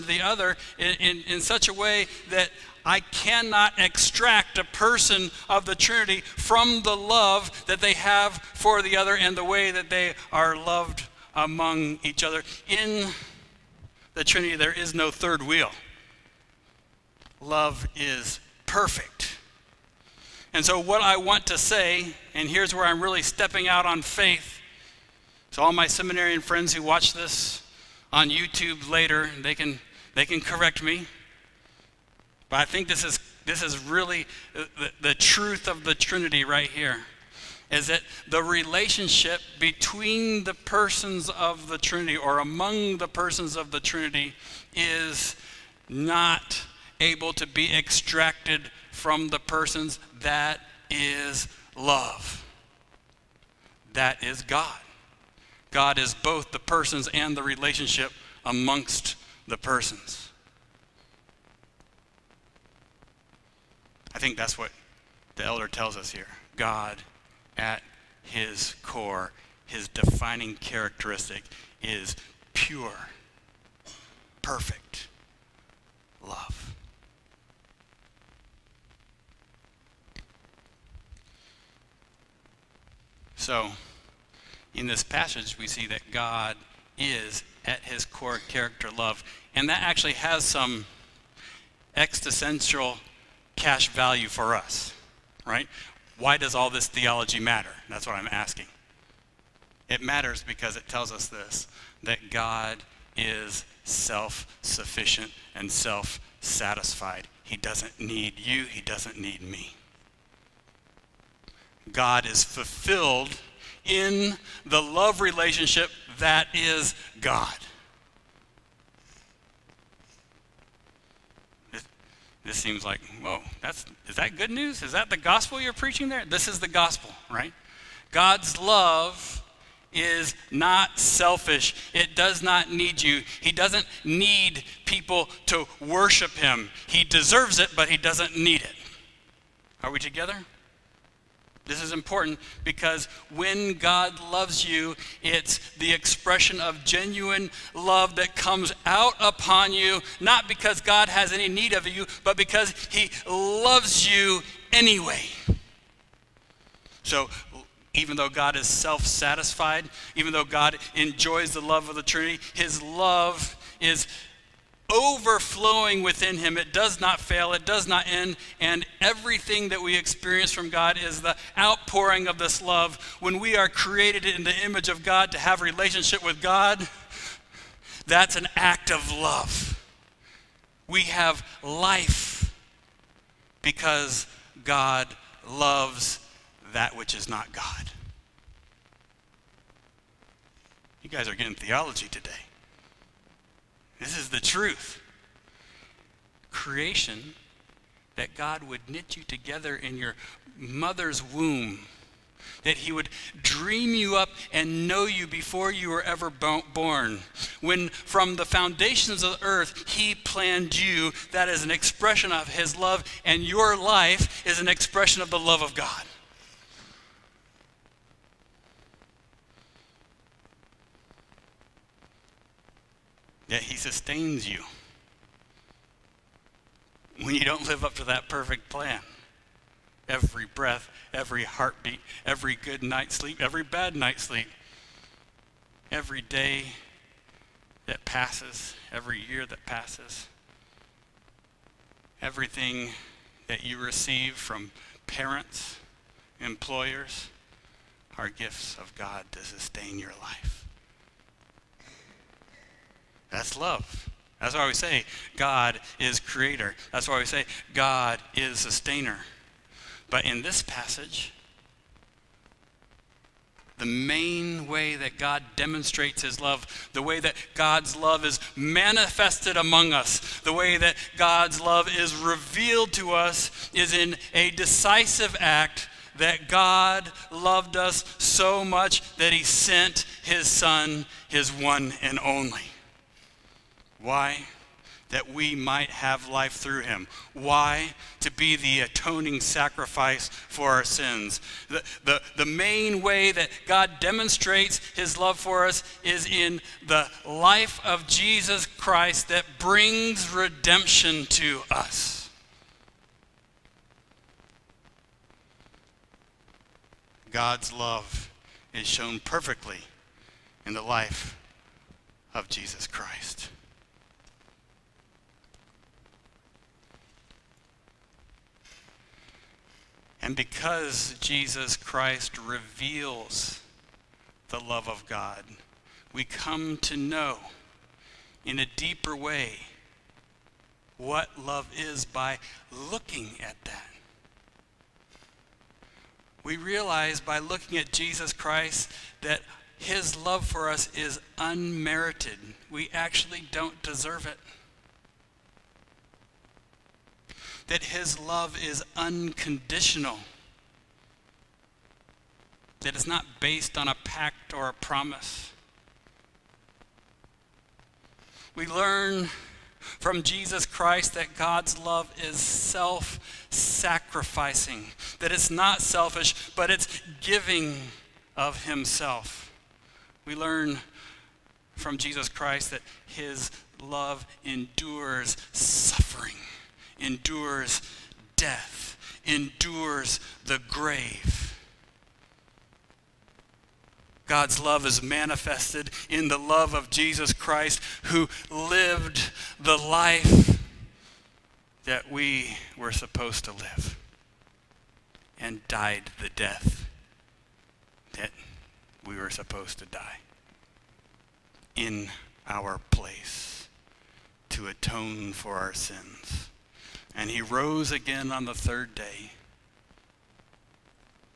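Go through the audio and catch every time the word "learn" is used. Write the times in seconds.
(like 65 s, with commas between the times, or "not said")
358 s, 370 s.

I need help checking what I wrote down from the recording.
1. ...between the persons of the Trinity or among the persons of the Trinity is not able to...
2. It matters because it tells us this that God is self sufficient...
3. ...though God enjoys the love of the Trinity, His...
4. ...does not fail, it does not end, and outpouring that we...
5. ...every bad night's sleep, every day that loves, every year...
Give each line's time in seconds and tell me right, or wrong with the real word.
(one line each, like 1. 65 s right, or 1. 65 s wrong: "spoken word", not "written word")
1. 39 s right
2. 99 s right
3. 160 s right
4. 166 s wrong: "everything", not "outpouring"
5. 233 s wrong: "passes", not "loves".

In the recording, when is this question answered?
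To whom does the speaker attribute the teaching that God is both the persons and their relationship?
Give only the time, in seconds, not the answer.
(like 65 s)
65 s.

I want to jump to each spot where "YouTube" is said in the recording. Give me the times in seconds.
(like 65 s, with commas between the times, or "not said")
28 s.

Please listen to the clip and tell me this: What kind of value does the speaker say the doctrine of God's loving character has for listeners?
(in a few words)
existential cash value.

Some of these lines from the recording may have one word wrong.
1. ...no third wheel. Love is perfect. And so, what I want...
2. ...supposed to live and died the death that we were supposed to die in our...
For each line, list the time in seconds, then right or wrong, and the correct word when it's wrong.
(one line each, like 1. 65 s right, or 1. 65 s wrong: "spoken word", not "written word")
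1. 14 s right
2. 392 s right.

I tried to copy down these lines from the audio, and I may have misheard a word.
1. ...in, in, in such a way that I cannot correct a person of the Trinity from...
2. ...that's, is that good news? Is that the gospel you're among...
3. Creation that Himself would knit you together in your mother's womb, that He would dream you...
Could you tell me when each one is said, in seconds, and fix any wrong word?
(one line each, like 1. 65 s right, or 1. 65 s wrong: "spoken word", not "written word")
1. 0 s wrong: "extract", not "correct"
2. 123 s wrong: "preaching", not "among"
3. 196 s wrong: "God", not "Himself".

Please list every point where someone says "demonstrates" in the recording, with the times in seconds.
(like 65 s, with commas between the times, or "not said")
265 s, 294 s.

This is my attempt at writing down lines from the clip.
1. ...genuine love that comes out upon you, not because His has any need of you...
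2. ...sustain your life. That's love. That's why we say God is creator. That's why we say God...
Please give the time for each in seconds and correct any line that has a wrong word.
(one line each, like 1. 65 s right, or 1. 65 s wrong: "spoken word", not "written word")
1. 146 s wrong: "God", not "His"
2. 249 s right.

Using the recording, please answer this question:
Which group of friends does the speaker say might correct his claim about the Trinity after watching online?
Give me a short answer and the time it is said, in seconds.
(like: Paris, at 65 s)
seminarian friends, at 25 s.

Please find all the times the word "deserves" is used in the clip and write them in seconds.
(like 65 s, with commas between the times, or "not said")
137 s, 343 s.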